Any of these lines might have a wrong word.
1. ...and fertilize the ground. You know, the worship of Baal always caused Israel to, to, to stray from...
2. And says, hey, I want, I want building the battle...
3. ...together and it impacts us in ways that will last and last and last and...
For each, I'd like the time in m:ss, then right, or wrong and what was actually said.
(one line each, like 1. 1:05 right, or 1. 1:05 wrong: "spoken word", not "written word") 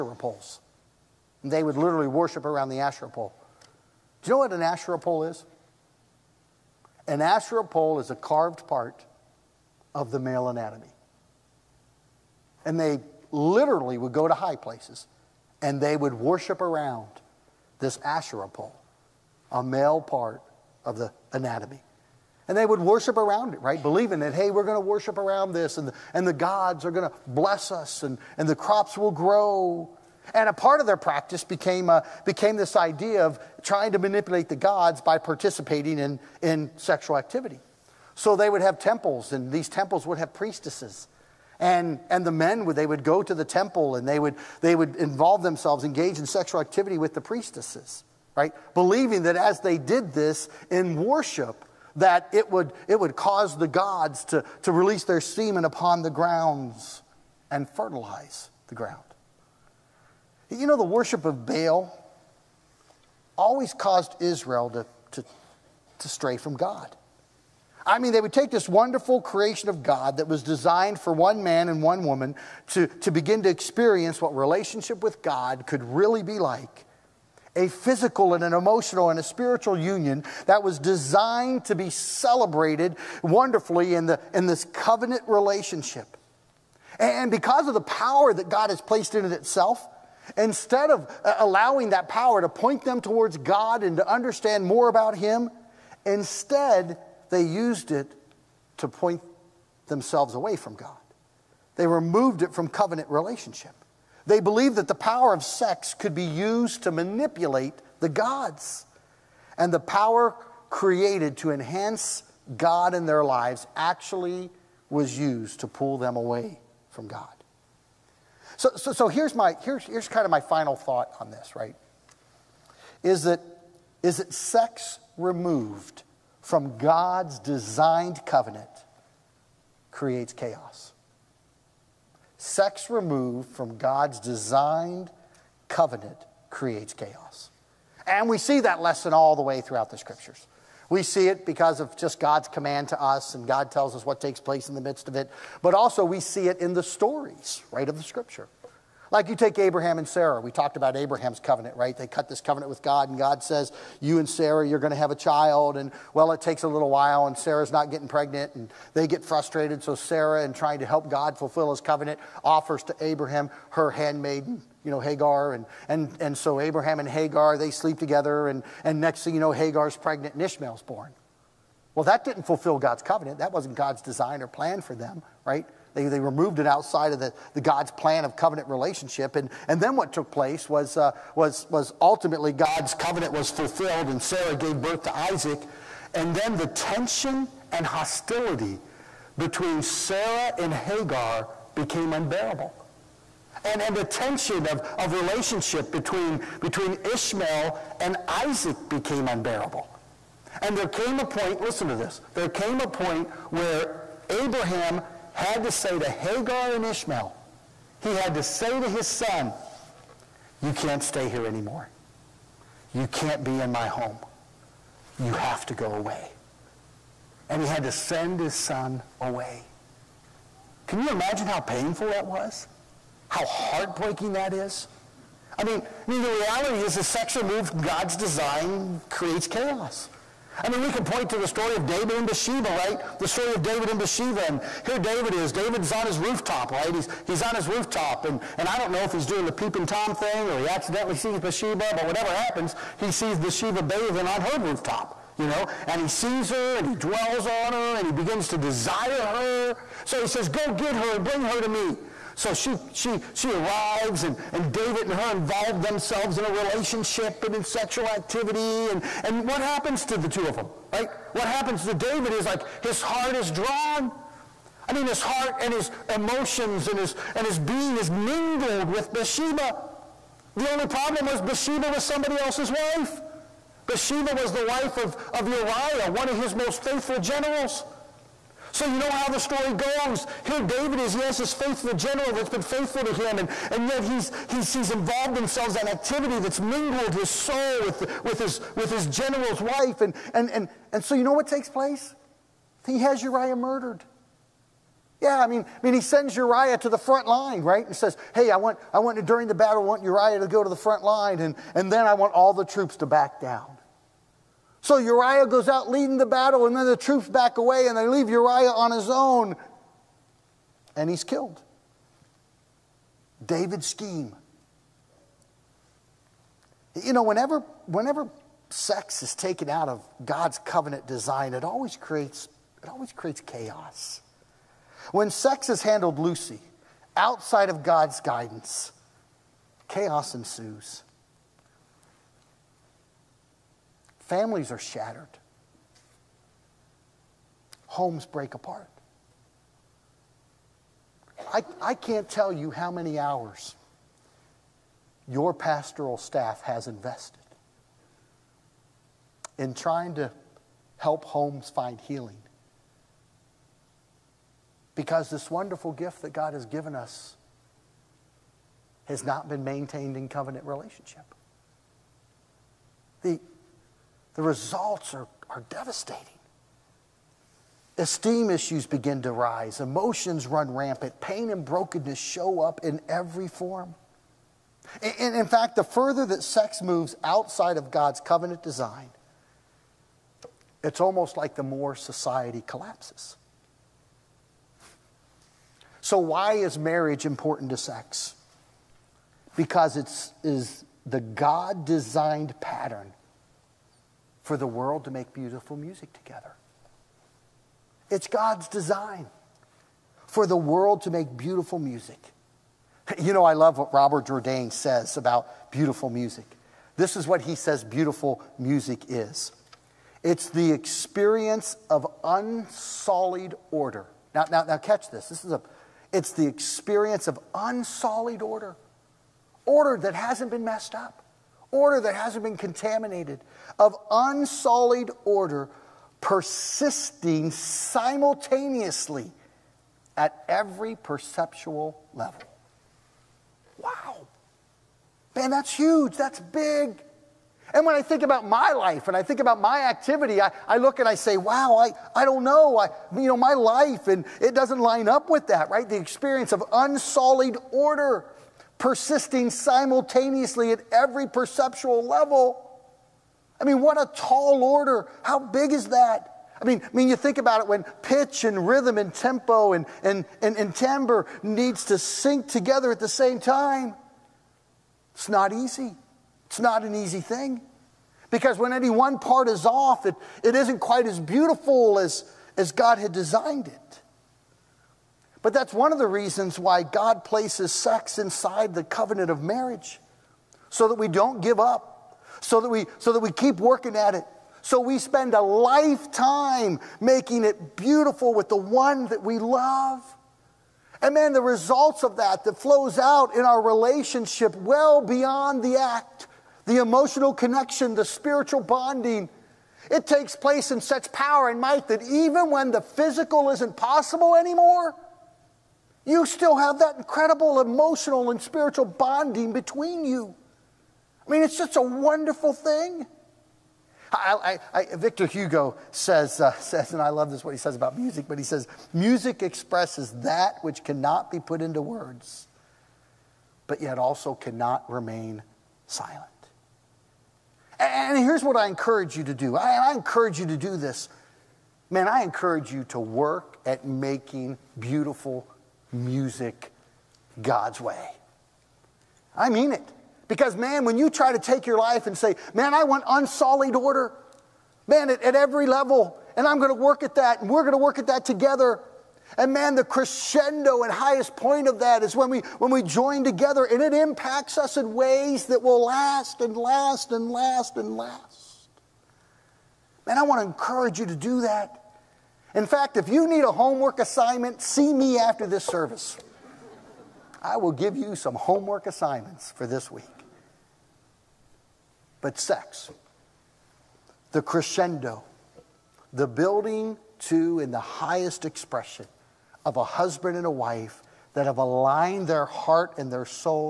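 1. 0:57 right
2. 4:57 wrong: "during", not "building"
3. 9:13 right.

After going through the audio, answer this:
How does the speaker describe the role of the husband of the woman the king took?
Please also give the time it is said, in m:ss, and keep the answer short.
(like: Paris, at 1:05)
One of his most faithful generals, at 4:36.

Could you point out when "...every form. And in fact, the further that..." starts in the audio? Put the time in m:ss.
6:13.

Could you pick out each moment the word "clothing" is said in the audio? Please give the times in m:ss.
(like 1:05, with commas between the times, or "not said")
not said.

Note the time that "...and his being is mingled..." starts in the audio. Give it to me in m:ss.
4:27.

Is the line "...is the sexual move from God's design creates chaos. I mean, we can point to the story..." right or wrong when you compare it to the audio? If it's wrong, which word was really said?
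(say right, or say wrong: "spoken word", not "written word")
right.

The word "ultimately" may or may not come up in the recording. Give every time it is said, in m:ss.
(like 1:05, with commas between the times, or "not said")
3:02.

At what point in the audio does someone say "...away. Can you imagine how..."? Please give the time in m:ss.
3:39.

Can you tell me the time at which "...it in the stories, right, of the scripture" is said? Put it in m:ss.
2:26.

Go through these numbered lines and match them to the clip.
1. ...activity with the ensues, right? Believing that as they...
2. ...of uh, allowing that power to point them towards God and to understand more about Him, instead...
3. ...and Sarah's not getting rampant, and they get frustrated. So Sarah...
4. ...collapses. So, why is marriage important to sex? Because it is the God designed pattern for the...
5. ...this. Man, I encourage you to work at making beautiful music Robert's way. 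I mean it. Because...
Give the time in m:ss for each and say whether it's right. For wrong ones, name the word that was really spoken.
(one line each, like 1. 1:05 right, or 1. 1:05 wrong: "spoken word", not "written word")
1. 0:46 wrong: "priestesses", not "ensues"
2. 1:30 right
3. 2:37 wrong: "pregnant", not "rampant"
4. 6:22 right
5. 8:50 wrong: "God", not "Robert".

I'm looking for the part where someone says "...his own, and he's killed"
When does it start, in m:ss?
5:08.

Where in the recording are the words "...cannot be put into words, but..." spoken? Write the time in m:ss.
8:40.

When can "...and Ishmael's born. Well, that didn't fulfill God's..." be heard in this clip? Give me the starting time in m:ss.
2:50.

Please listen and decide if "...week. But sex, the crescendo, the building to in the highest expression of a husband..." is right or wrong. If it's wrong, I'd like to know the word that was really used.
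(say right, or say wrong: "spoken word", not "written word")
right.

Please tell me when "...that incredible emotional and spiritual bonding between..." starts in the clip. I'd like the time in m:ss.
8:26.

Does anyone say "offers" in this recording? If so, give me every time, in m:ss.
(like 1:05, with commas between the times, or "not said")
2:42.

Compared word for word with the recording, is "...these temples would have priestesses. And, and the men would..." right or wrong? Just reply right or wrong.
right.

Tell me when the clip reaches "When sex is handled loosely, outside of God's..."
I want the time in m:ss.
5:25.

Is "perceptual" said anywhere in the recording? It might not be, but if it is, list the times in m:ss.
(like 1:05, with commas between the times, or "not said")
7:10, 7:31.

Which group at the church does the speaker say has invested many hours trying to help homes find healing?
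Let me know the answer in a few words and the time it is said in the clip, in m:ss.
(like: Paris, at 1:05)
Pastoral staff, at 5:45.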